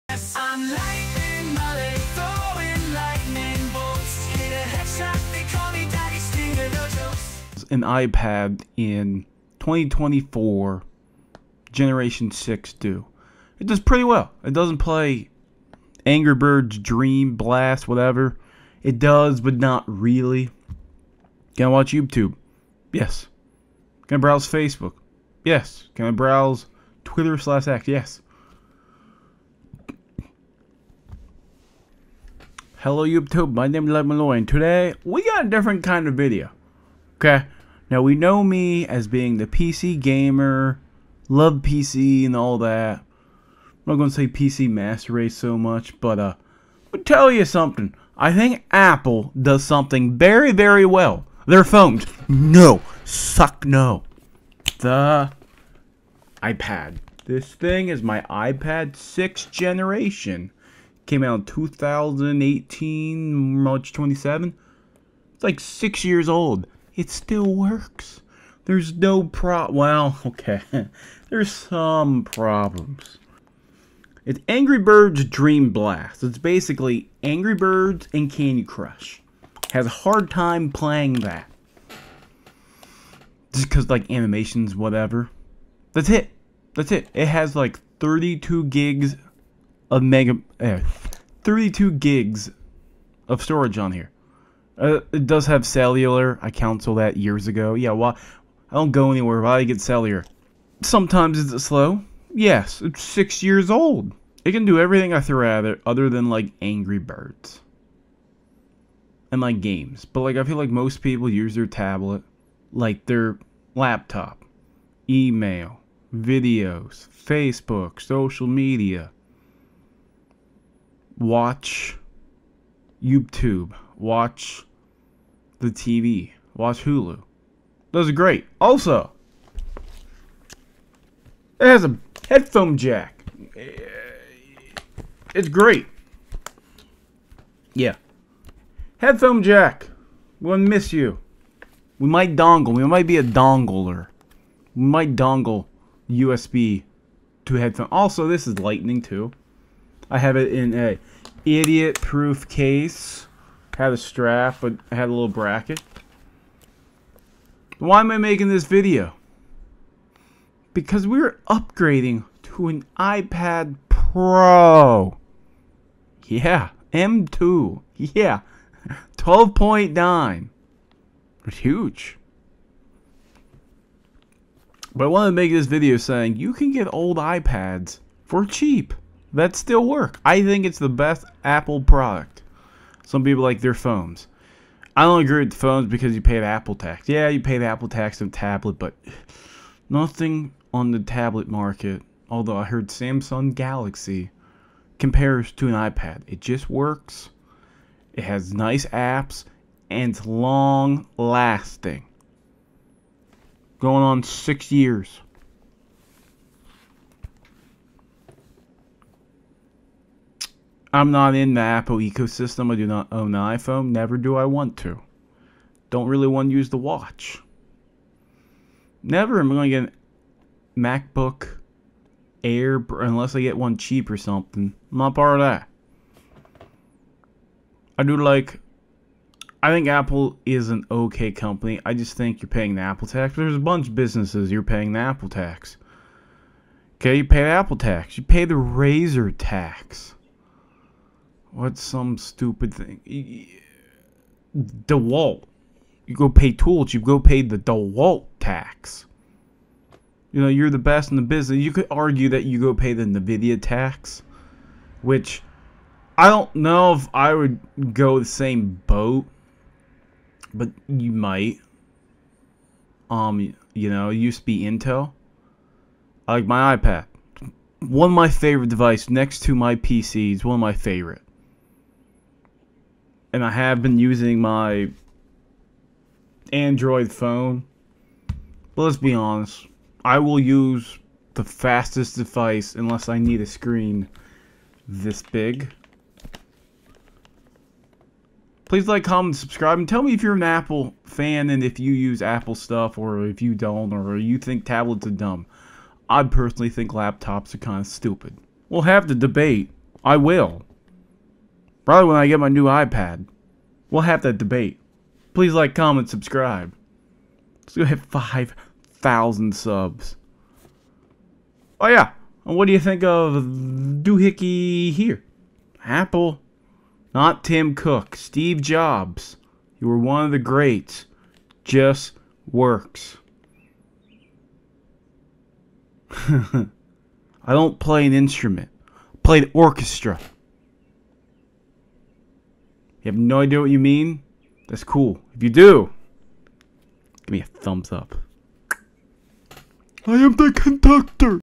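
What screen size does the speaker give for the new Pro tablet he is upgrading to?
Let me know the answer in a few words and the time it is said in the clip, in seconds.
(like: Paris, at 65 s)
12.9, at 169 s.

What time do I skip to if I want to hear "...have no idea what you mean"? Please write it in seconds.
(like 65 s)
333 s.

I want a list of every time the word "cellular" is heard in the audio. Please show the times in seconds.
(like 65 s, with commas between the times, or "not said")
95 s, 99 s.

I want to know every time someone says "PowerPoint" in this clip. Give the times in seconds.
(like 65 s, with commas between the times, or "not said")
not said.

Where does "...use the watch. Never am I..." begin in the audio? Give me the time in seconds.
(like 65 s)
216 s.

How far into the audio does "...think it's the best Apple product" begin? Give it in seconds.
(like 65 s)
180 s.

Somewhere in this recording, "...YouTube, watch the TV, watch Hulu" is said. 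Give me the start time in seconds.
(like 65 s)
123 s.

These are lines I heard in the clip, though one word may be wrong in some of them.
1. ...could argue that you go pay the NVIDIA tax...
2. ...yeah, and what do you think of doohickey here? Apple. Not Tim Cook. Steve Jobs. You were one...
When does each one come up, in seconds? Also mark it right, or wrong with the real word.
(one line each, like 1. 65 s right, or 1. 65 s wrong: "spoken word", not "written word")
1. 251 s right
2. 311 s right.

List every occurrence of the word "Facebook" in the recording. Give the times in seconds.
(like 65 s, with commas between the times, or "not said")
24 s, 117 s.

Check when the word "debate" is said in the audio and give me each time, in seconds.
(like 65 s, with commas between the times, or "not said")
299 s, 304 s.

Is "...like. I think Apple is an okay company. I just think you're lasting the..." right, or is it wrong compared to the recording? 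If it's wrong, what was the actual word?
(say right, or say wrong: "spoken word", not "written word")
wrong: "paying", not "lasting".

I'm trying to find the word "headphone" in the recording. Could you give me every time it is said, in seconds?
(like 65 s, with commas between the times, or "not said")
132 s, 138 s, 147 s.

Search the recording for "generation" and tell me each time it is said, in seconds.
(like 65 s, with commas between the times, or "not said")
11 s, 59 s.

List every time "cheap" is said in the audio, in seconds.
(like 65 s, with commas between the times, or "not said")
178 s, 223 s.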